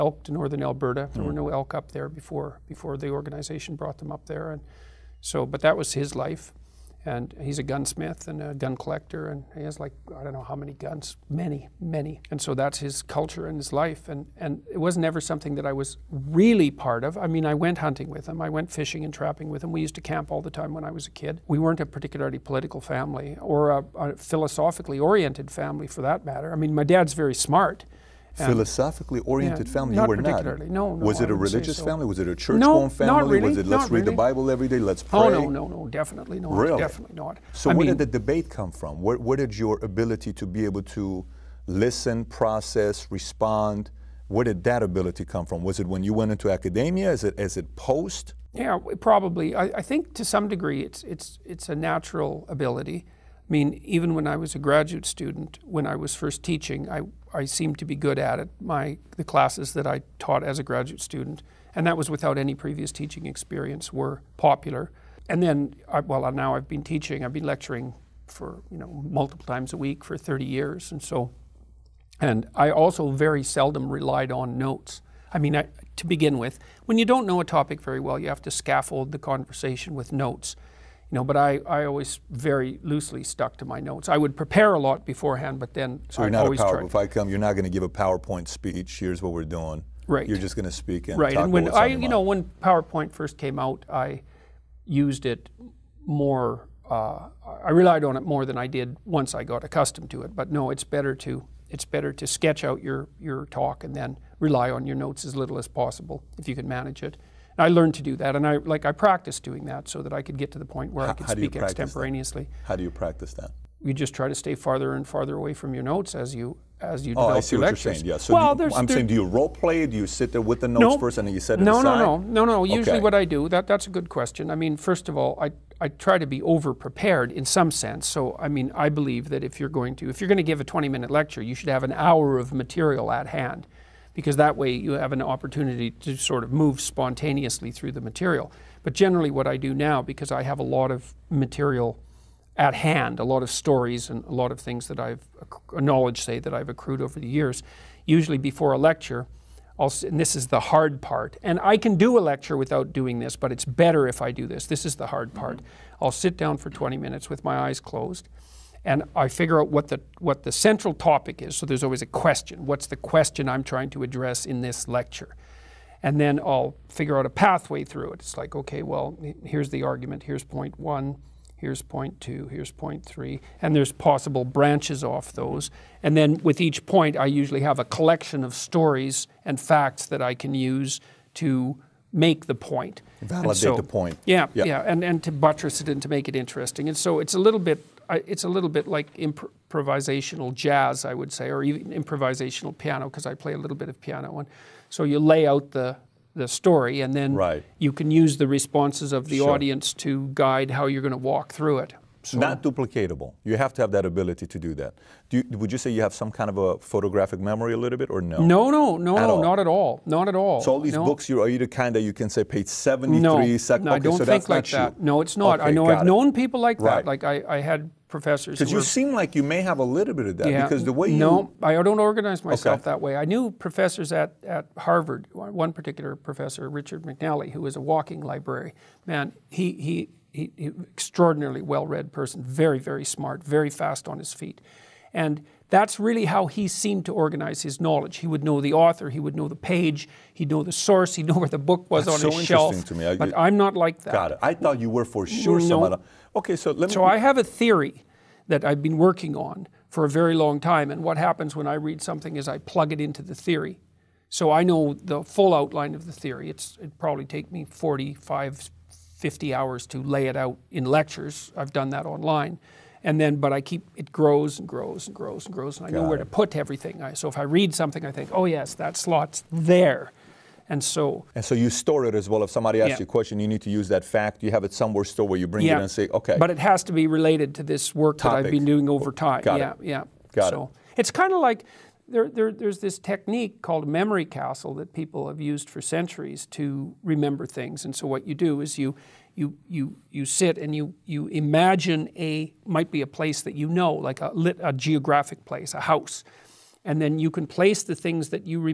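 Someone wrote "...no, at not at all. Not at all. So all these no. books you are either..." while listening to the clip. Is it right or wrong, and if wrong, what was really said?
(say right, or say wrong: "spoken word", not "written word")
right.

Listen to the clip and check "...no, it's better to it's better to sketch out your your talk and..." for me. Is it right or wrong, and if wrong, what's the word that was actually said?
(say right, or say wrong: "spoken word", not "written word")
right.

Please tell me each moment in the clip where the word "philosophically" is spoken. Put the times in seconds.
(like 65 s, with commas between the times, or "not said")
24 s, 28 s.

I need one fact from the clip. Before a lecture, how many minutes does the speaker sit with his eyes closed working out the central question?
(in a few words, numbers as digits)
20.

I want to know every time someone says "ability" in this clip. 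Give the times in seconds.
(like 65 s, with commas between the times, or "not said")
39 s, 44 s, 52 s, 204 s.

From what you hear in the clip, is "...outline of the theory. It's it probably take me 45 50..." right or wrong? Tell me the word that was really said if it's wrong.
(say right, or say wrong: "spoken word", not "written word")
right.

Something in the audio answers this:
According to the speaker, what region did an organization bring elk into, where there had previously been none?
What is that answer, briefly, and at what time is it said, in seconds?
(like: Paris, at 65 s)
northern Alberta, at 0 s.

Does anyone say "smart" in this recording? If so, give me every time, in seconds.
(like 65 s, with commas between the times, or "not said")
27 s, 233 s.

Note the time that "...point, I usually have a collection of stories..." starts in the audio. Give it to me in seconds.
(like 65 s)
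176 s.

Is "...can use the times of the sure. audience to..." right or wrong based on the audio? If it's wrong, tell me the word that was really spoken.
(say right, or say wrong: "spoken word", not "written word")
wrong: "responses", not "times".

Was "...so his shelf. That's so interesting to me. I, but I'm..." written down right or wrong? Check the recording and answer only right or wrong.
right.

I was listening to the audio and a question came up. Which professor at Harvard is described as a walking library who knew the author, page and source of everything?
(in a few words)
Richard McNally.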